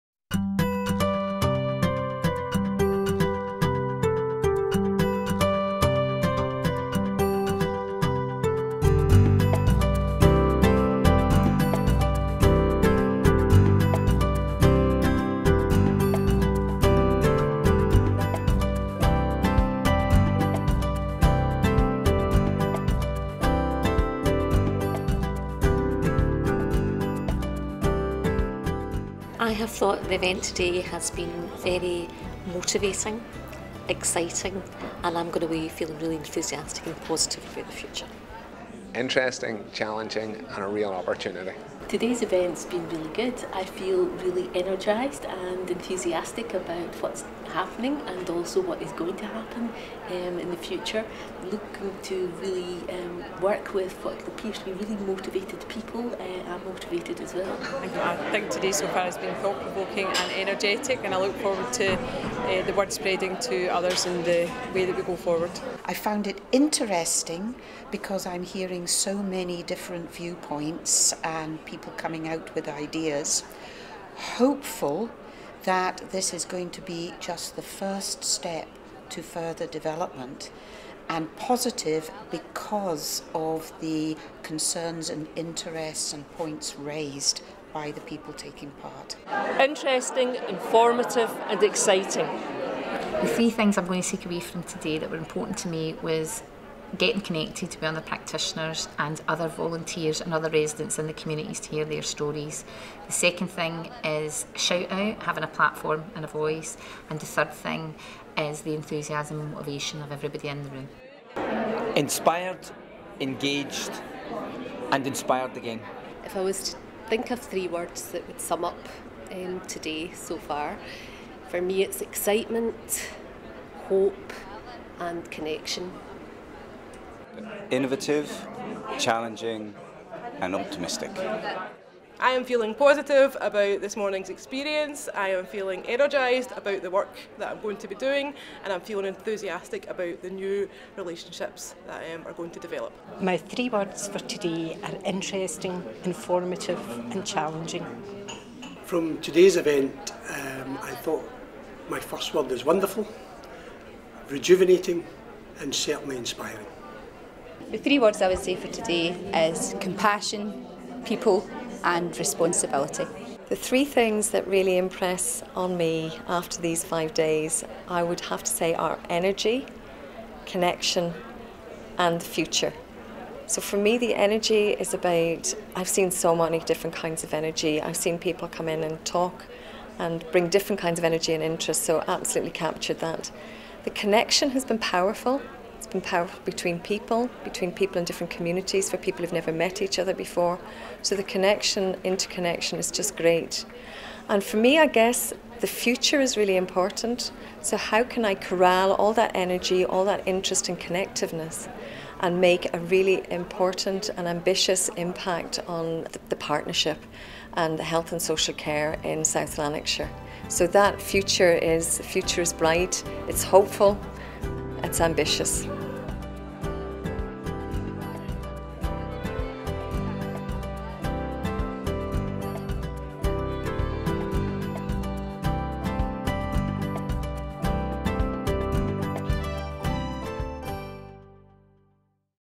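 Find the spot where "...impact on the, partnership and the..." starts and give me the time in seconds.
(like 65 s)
204 s.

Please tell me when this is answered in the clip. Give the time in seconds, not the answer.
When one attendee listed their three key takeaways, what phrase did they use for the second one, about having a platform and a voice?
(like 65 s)
104 s.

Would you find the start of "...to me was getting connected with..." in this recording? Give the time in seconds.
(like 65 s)
95 s.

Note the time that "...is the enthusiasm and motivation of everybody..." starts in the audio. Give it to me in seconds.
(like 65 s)
108 s.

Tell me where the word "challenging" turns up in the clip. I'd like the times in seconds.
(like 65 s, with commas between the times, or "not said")
39 s, 128 s, 147 s.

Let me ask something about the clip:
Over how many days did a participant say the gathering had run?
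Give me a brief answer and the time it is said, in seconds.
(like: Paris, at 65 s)
5 days, at 166 s.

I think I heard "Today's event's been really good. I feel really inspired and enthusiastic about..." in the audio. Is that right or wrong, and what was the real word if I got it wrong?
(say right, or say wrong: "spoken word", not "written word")
wrong: "energised", not "inspired".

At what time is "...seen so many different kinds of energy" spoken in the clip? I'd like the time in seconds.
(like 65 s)
175 s.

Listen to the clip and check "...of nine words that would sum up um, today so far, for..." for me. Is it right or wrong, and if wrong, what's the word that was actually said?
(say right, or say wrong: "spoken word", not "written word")
wrong: "three", not "nine".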